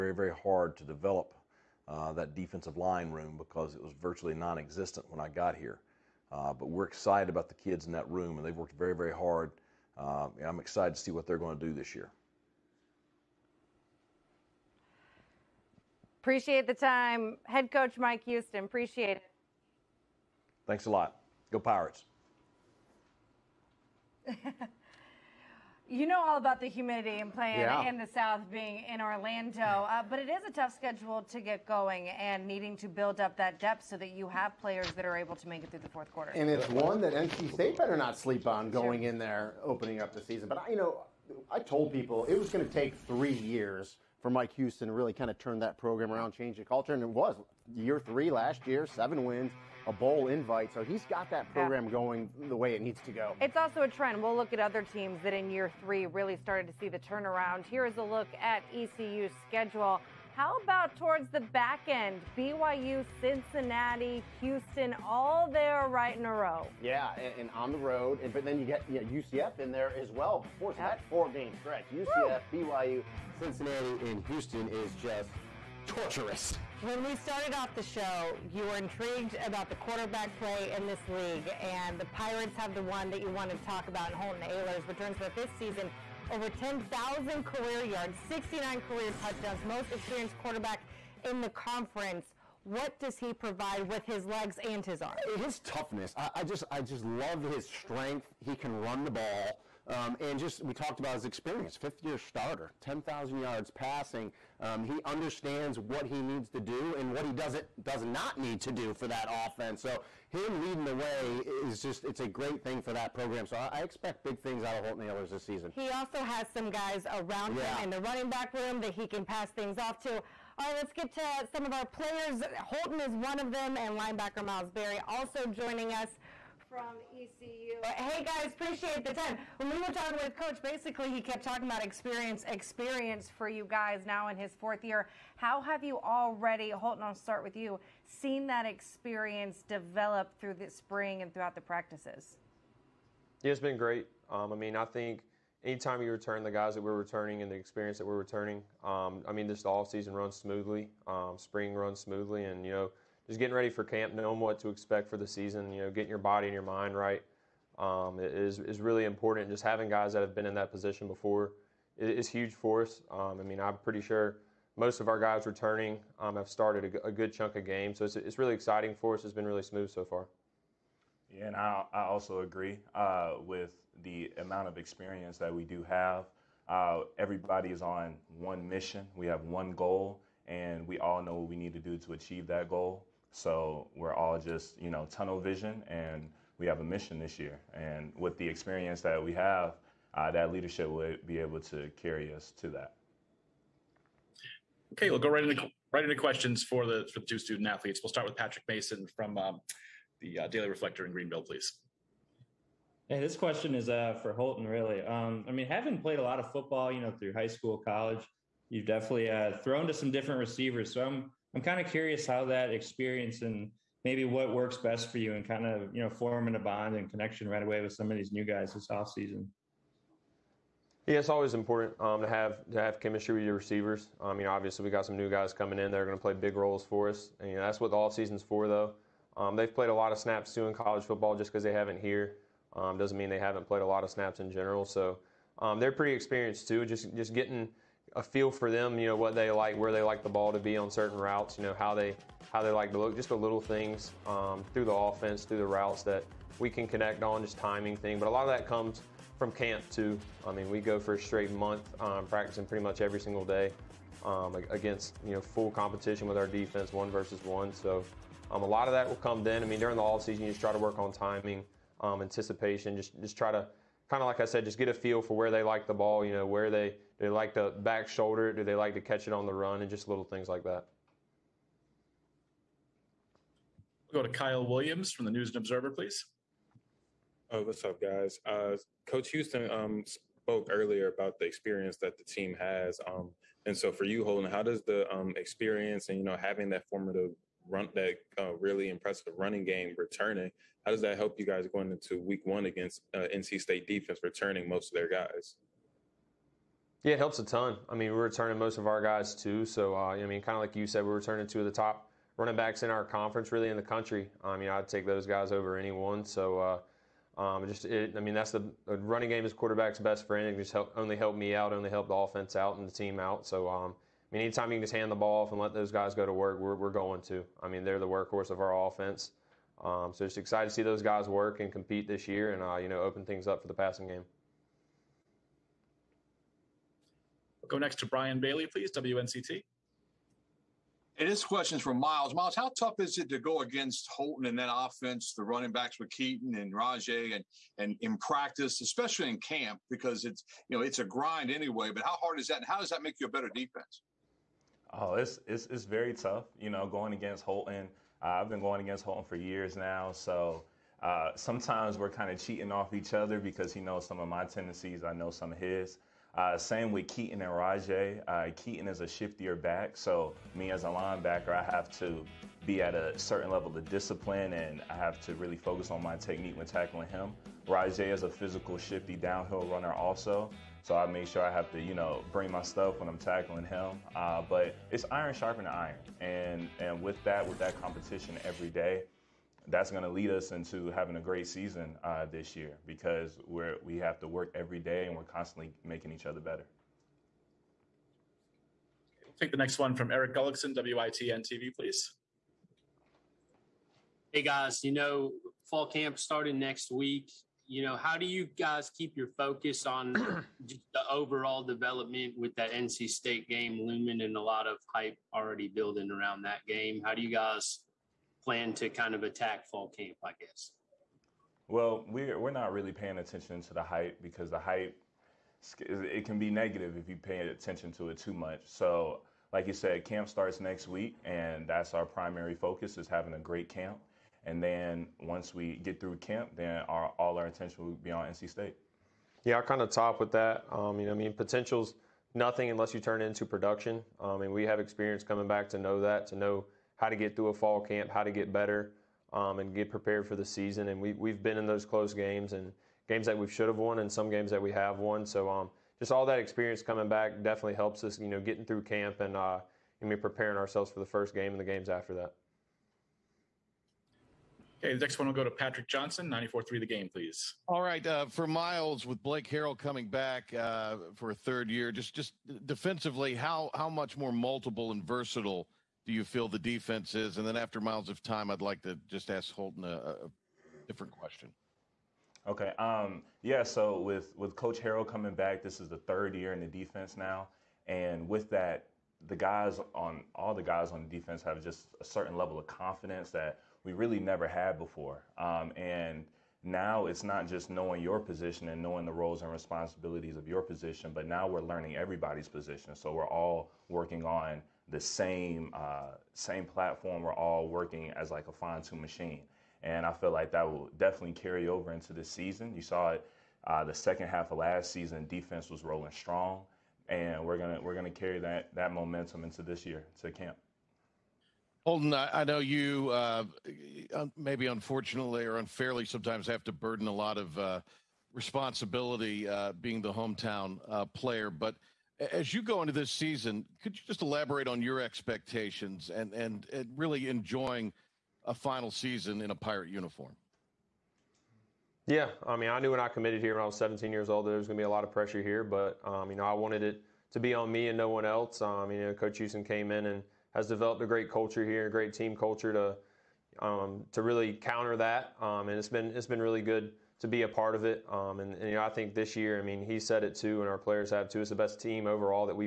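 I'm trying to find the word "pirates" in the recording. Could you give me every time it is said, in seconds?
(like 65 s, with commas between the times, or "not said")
21 s, 82 s, 529 s.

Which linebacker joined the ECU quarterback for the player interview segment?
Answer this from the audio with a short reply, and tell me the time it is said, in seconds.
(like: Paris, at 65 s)
Myles Berry, at 124 s.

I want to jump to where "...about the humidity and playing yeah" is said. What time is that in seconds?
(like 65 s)
26 s.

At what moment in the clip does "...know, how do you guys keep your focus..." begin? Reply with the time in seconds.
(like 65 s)
397 s.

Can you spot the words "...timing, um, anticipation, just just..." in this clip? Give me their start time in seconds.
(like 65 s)
261 s.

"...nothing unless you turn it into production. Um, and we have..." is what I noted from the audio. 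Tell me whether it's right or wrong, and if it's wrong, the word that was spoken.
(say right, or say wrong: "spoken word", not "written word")
right.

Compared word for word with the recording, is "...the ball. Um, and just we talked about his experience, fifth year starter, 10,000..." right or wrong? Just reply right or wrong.
right.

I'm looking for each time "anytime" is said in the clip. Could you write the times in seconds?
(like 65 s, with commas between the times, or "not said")
145 s, 314 s.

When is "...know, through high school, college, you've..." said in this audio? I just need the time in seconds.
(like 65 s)
206 s.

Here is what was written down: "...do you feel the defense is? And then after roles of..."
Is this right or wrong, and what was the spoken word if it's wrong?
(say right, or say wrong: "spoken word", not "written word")
wrong: "miles", not "roles".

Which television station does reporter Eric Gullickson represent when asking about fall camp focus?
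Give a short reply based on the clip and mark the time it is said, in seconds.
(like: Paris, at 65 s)
WITN, at 390 s.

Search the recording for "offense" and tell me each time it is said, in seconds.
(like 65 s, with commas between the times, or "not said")
109 s, 244 s, 312 s, 318 s, 334 s.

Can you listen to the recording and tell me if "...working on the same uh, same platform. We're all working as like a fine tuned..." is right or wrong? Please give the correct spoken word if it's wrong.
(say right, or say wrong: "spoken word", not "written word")
right.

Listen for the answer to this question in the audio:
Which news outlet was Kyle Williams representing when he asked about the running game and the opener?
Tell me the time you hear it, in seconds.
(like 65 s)
275 s.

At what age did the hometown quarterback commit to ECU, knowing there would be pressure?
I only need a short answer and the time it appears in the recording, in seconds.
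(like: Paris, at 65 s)
17, at 533 s.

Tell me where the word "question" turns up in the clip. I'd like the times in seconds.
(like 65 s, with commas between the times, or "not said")
196 s, 203 s, 331 s, 471 s.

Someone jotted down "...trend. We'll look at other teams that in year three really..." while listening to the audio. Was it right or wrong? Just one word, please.
right.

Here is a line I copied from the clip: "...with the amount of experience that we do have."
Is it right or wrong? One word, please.
right.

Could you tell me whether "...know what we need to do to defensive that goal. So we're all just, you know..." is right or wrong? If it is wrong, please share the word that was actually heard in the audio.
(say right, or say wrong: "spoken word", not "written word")
wrong: "achieve", not "defensive".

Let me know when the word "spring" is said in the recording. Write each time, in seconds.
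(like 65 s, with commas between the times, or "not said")
140 s, 151 s.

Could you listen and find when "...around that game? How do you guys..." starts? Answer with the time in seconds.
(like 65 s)
406 s.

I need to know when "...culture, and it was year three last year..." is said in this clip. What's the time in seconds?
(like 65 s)
46 s.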